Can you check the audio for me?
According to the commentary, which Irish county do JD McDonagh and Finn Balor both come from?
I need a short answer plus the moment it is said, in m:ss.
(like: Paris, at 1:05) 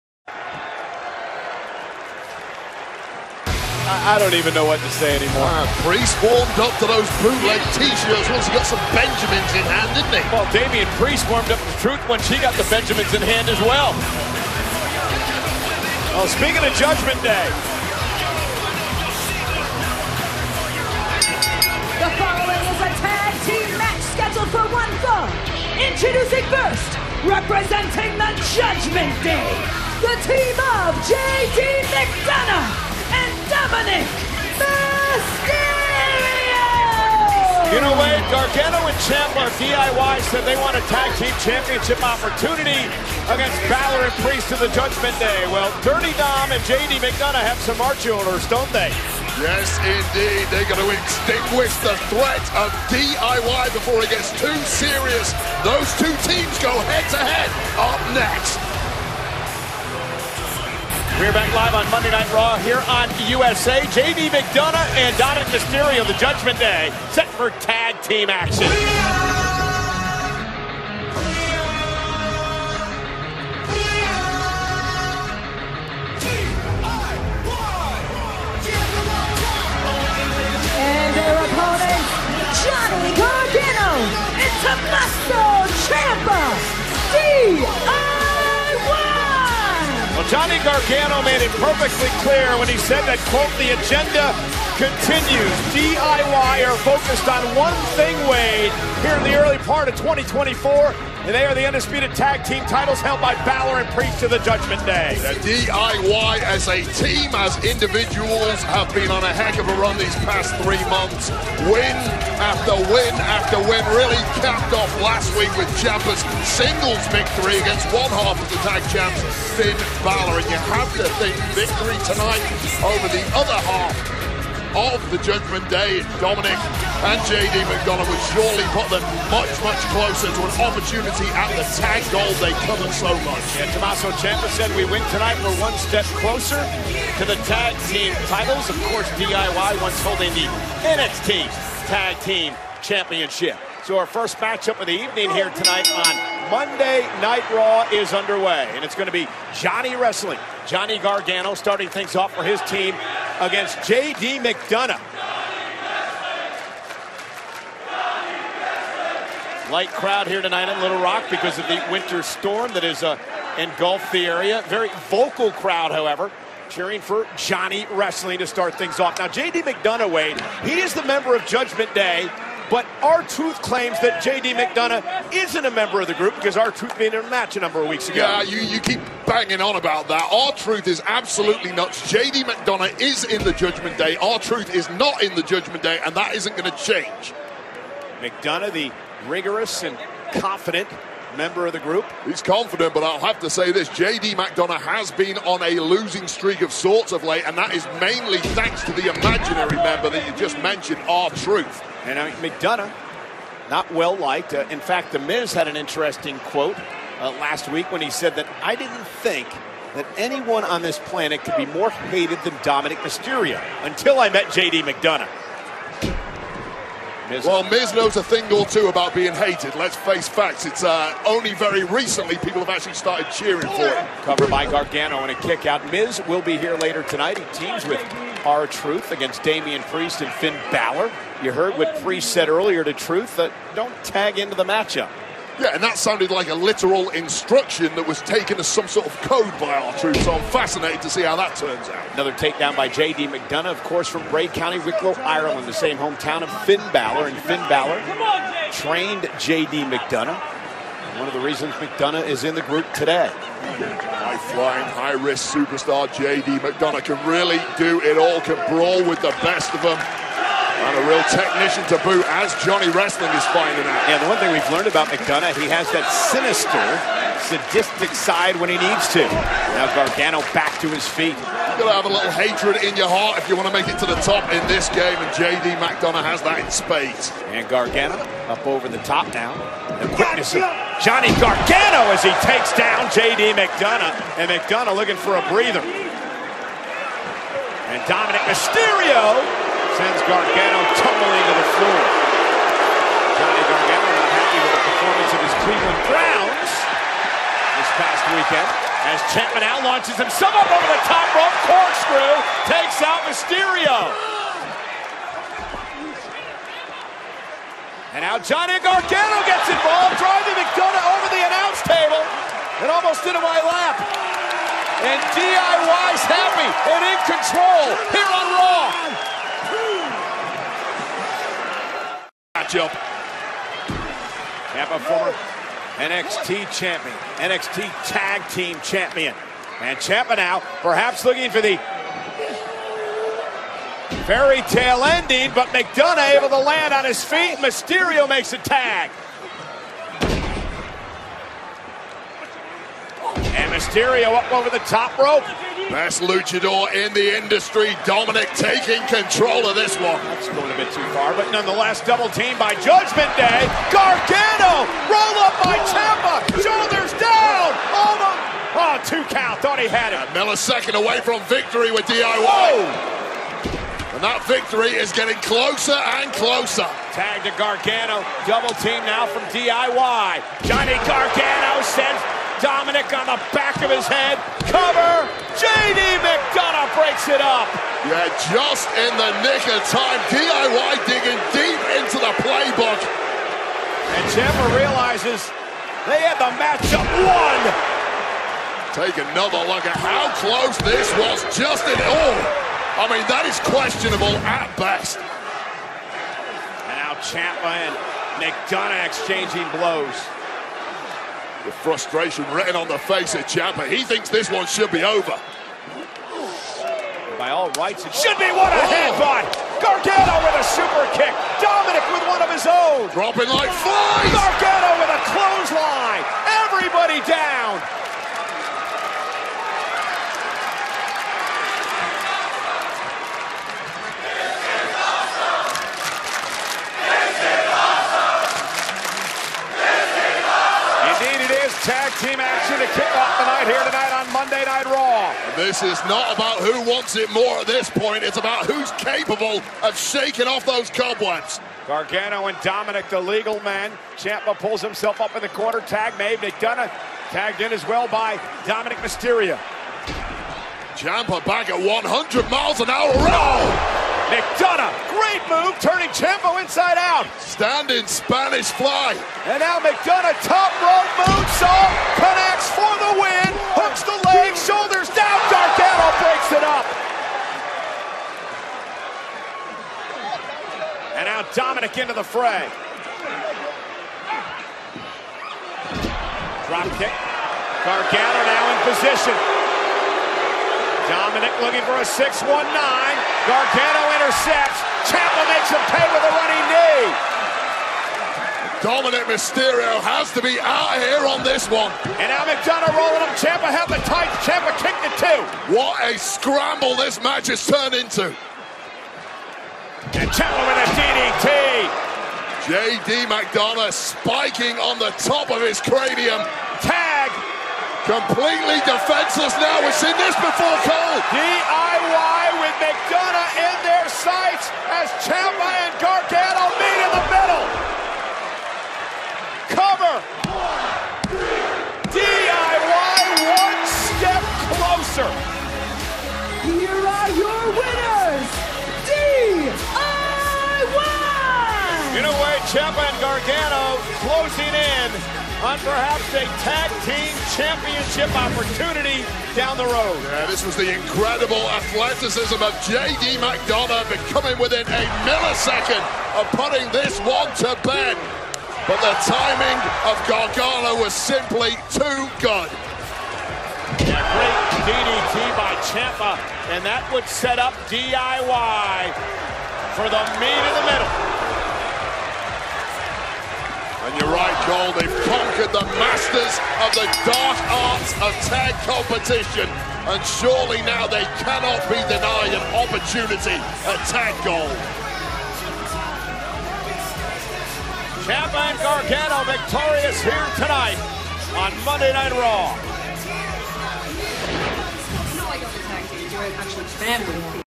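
Wicklow, at 4:04.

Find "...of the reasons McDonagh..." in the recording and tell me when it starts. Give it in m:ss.
4:11.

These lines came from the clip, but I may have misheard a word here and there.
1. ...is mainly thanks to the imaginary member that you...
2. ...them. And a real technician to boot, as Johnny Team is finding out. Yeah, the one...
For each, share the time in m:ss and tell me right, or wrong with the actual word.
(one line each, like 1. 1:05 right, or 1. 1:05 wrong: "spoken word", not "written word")
1. 3:17 right
2. 4:19 wrong: "Wrestling", not "Team".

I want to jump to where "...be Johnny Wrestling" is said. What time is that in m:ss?
2:29.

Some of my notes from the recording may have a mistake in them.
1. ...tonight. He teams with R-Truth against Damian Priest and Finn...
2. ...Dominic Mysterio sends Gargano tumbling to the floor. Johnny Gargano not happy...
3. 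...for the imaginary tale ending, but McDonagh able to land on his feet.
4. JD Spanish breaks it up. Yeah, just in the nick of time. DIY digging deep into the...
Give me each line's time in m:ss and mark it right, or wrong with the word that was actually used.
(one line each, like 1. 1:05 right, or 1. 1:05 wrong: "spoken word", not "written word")
1. 3:47 right
2. 4:48 right
3. 5:31 wrong: "fairy", not "imaginary"
4. 6:15 wrong: "McDonagh", not "Spanish".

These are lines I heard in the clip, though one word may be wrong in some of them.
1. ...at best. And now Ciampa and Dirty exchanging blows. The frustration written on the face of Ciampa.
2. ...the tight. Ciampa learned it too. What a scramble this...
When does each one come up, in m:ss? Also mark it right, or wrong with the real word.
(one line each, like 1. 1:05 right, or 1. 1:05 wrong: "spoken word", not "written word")
1. 6:34 wrong: "McDonagh", not "Dirty"
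2. 8:13 wrong: "kicked", not "learned".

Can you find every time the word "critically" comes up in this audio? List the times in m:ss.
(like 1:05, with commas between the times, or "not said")
not said.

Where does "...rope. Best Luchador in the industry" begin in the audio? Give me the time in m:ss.
5:45.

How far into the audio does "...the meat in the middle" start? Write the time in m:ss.
9:20.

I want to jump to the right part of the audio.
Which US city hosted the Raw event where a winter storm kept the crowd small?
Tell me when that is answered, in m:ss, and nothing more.
2:40.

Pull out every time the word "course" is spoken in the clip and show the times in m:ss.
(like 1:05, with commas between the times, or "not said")
2:18, 4:03.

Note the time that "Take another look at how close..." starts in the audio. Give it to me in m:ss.
6:28.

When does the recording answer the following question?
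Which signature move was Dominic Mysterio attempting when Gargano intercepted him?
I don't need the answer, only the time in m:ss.
8:02.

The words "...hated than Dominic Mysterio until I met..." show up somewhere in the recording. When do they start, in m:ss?
3:31.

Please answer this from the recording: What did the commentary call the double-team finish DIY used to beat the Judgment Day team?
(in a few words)
Meet in the middle.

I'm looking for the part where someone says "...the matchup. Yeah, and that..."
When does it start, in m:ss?
3:54.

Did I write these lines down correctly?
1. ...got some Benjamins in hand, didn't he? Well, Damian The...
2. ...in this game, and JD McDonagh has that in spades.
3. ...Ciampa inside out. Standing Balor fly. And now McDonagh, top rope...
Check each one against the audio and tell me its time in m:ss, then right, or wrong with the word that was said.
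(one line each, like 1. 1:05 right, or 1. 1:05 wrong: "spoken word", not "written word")
1. 0:08 wrong: "Priest", not "The"
2. 4:34 right
3. 7:36 wrong: "Spanish", not "Balor".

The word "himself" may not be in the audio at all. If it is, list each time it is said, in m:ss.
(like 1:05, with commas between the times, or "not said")
5:00, 7:24.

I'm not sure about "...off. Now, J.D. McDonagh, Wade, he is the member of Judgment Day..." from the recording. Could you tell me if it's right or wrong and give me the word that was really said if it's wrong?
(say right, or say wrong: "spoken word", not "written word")
right.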